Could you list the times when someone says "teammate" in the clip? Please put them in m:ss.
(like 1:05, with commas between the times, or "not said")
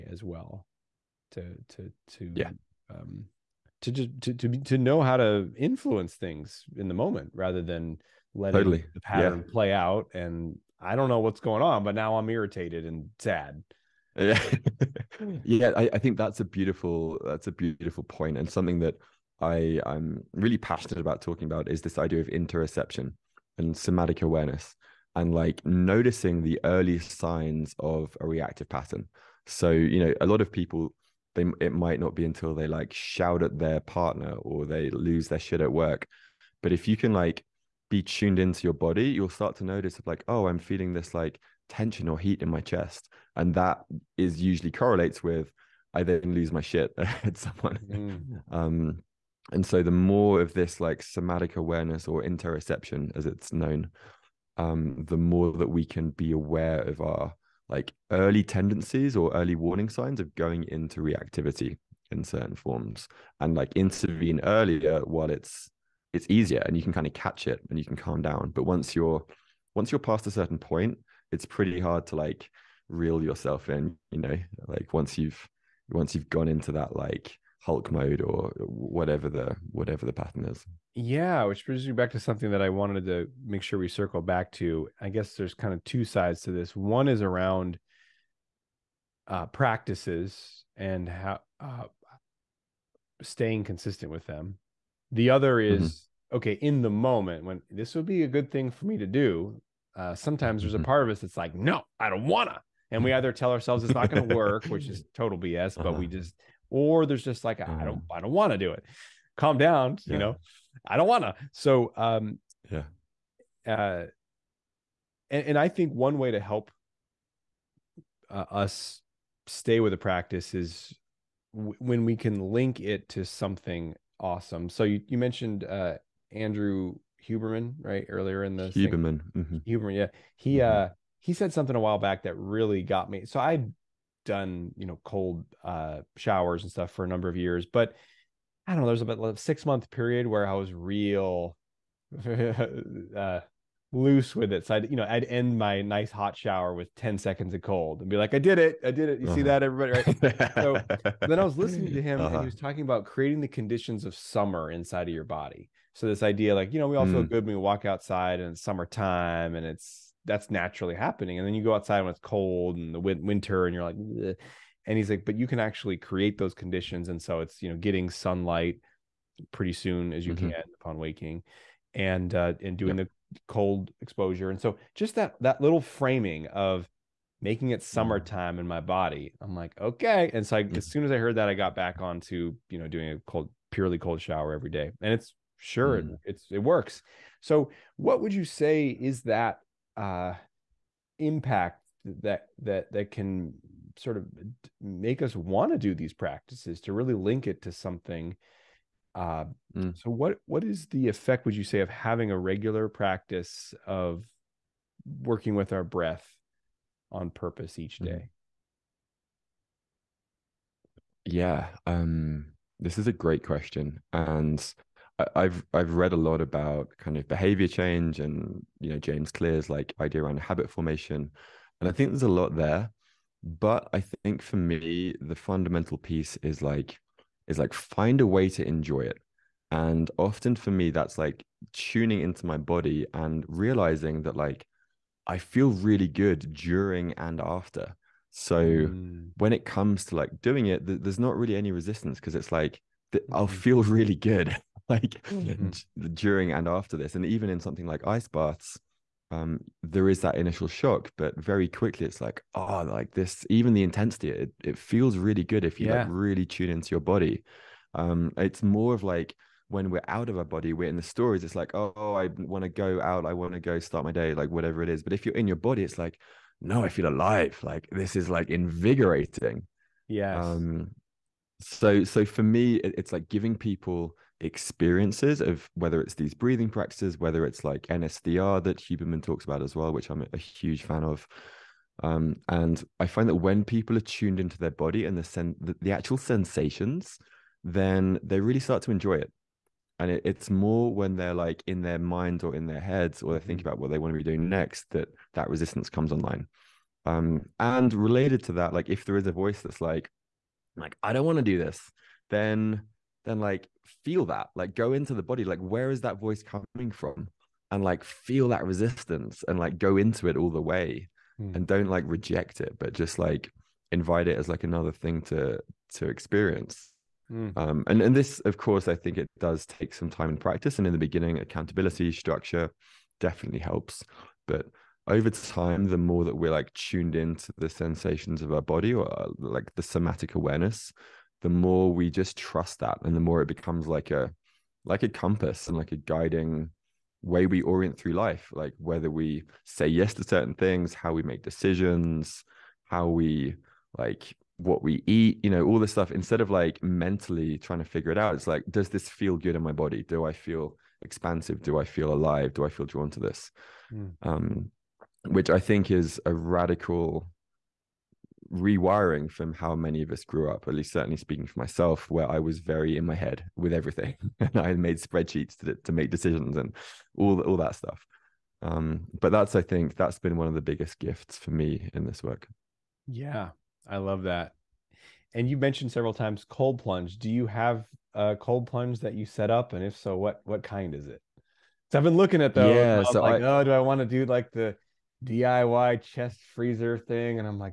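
not said.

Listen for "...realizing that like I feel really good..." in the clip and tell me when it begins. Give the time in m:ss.
3:53.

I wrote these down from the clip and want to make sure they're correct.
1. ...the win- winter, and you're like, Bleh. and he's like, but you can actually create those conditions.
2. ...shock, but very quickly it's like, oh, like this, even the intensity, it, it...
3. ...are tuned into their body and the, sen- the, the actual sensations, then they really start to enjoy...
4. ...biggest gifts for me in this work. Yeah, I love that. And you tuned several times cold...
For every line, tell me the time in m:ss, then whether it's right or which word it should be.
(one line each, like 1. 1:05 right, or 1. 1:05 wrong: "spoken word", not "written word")
1. 2:42 right
2. 4:10 right
3. 4:43 right
4. 6:10 wrong: "mentioned", not "tuned".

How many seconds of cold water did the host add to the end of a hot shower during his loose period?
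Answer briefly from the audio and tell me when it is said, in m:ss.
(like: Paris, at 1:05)
10, at 2:26.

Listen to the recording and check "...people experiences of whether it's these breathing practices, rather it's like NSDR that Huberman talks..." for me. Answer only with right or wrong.
wrong.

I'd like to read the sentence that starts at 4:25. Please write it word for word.
But if you're in your body, it's like, no, I feel alive.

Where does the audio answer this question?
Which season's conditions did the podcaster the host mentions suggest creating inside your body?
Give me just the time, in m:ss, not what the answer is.
2:34.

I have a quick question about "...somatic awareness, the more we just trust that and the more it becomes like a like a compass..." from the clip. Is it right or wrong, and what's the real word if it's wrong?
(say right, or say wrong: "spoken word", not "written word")
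right.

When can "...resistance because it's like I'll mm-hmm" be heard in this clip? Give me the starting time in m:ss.
4:01.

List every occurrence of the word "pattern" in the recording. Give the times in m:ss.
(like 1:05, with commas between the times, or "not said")
0:08, 0:28, 1:20.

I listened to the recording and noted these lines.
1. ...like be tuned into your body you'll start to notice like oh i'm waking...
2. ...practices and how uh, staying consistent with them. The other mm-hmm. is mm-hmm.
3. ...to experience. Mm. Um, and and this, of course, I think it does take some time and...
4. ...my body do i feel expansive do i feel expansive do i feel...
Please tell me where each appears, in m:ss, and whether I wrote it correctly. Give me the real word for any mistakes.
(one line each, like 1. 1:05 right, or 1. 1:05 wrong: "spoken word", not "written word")
1. 0:37 wrong: "feeling", not "waking"
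2. 1:29 right
3. 5:15 right
4. 5:49 wrong: "alive", not "expansive".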